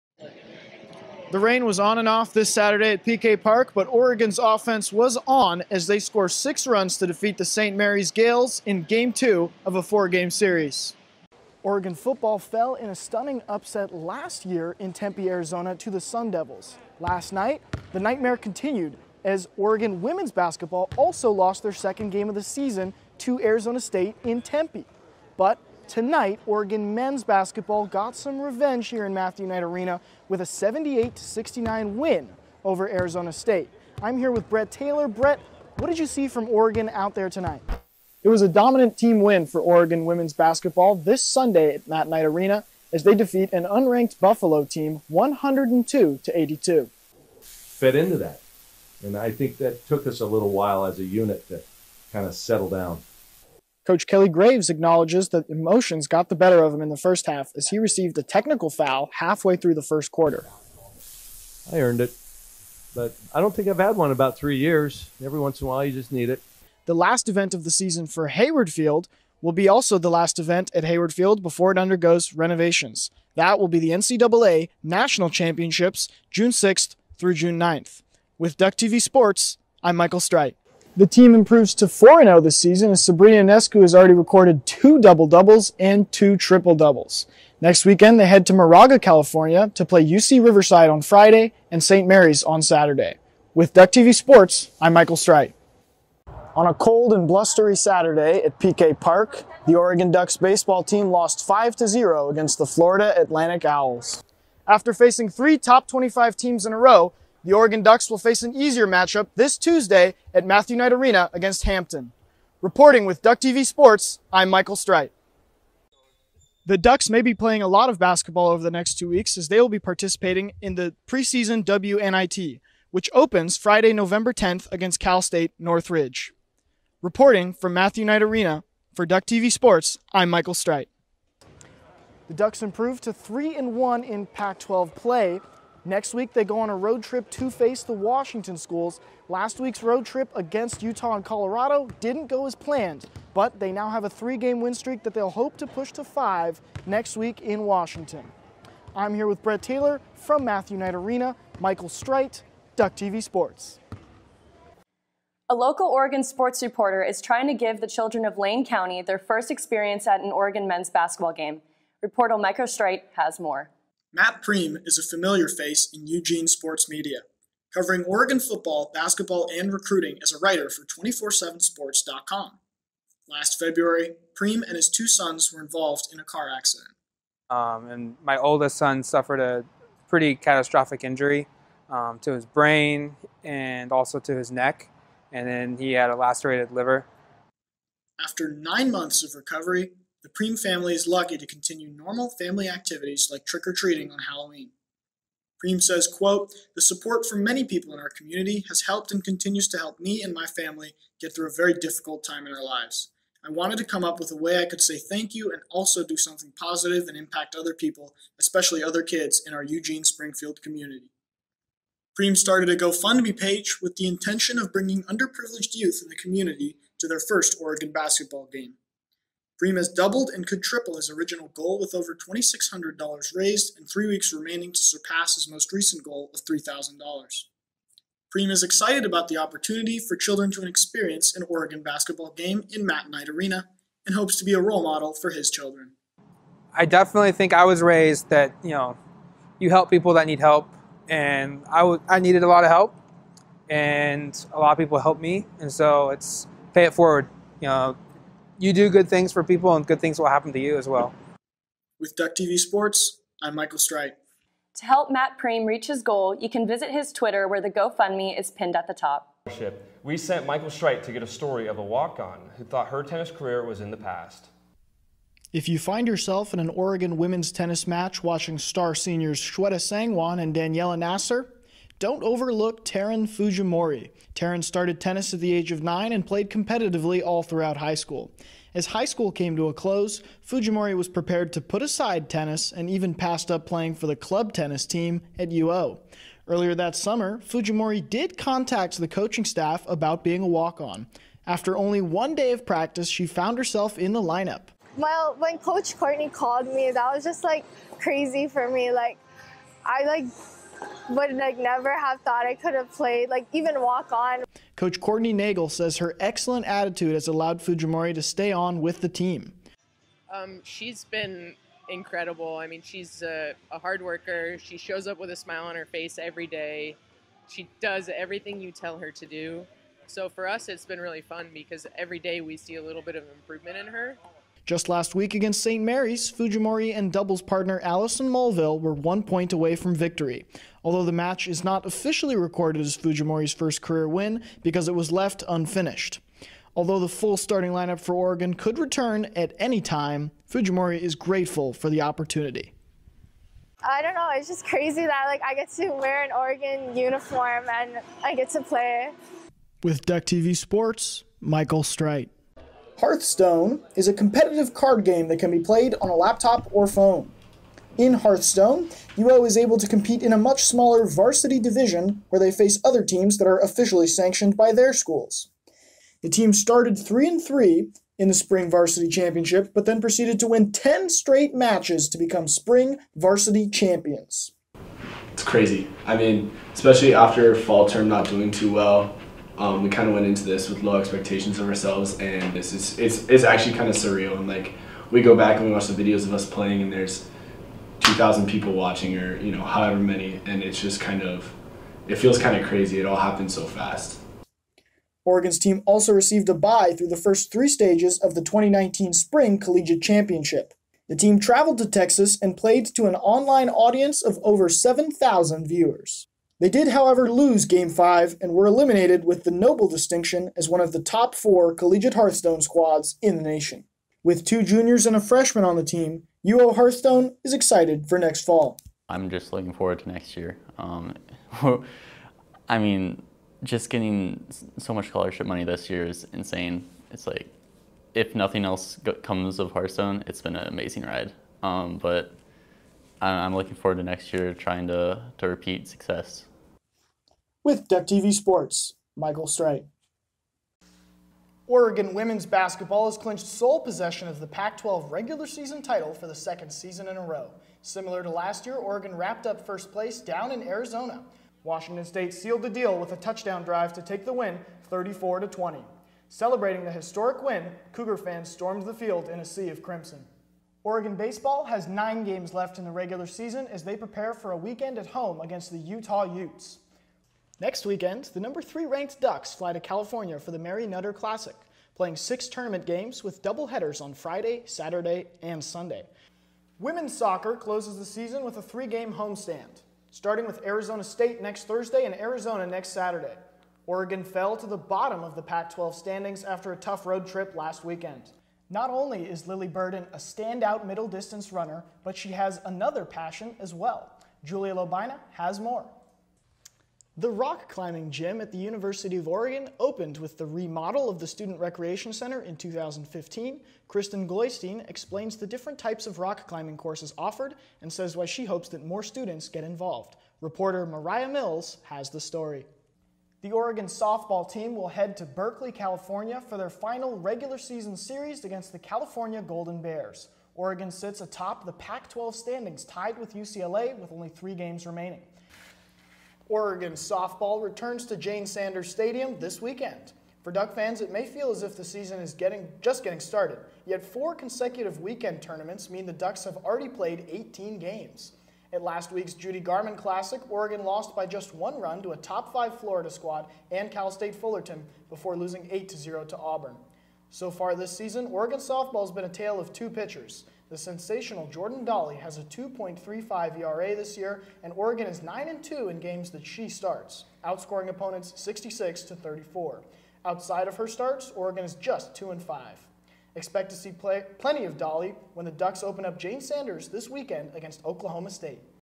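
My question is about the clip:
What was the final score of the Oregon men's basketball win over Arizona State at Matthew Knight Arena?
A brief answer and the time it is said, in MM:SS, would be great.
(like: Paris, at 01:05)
78-69, at 00:30.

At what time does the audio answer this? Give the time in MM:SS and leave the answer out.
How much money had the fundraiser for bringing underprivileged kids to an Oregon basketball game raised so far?
03:41.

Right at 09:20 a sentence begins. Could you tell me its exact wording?
Outside of her starts, Oregon is just 2 and 5.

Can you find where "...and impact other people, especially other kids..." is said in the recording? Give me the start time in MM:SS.
03:27.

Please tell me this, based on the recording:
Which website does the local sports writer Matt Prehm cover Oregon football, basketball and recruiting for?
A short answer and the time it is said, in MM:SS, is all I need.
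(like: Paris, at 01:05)
247sports.com, at 02:50.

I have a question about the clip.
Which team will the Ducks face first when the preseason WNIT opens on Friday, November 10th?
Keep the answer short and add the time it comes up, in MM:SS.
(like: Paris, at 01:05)
Cal State Northridge, at 02:04.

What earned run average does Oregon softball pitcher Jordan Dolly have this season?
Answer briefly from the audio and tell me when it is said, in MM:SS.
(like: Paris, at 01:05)
2.35, at 09:12.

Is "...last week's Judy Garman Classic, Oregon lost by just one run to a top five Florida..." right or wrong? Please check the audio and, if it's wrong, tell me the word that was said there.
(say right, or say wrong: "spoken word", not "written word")
right.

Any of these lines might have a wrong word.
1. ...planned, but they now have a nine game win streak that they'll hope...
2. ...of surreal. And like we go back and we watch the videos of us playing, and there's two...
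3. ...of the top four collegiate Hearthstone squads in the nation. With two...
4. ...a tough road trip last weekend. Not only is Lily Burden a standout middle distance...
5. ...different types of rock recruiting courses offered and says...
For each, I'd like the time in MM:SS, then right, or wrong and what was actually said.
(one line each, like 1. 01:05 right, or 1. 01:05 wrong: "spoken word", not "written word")
1. 02:22 wrong: "three", not "nine"
2. 06:23 right
3. 06:50 right
4. 08:06 right
5. 08:25 wrong: "climbing", not "recruiting".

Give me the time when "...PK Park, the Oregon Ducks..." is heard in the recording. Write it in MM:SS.
01:38.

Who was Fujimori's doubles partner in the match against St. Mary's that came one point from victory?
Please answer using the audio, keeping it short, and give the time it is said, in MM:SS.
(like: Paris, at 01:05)
Allison Mulville, at 05:27.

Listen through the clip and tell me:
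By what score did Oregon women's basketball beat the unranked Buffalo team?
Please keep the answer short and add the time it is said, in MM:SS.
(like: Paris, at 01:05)
102 to 82, at 00:45.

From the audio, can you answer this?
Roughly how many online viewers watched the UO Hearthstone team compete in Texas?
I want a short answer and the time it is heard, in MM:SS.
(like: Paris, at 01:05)
over 7,000, at 06:44.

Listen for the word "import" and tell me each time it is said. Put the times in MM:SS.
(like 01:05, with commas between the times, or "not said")
not said.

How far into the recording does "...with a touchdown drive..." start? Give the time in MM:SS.
07:32.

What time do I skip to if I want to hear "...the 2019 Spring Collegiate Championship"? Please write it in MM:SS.
06:38.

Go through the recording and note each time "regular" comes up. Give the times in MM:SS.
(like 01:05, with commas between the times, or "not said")
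07:25, 07:42, 08:37.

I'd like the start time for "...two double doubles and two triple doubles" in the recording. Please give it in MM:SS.
01:24.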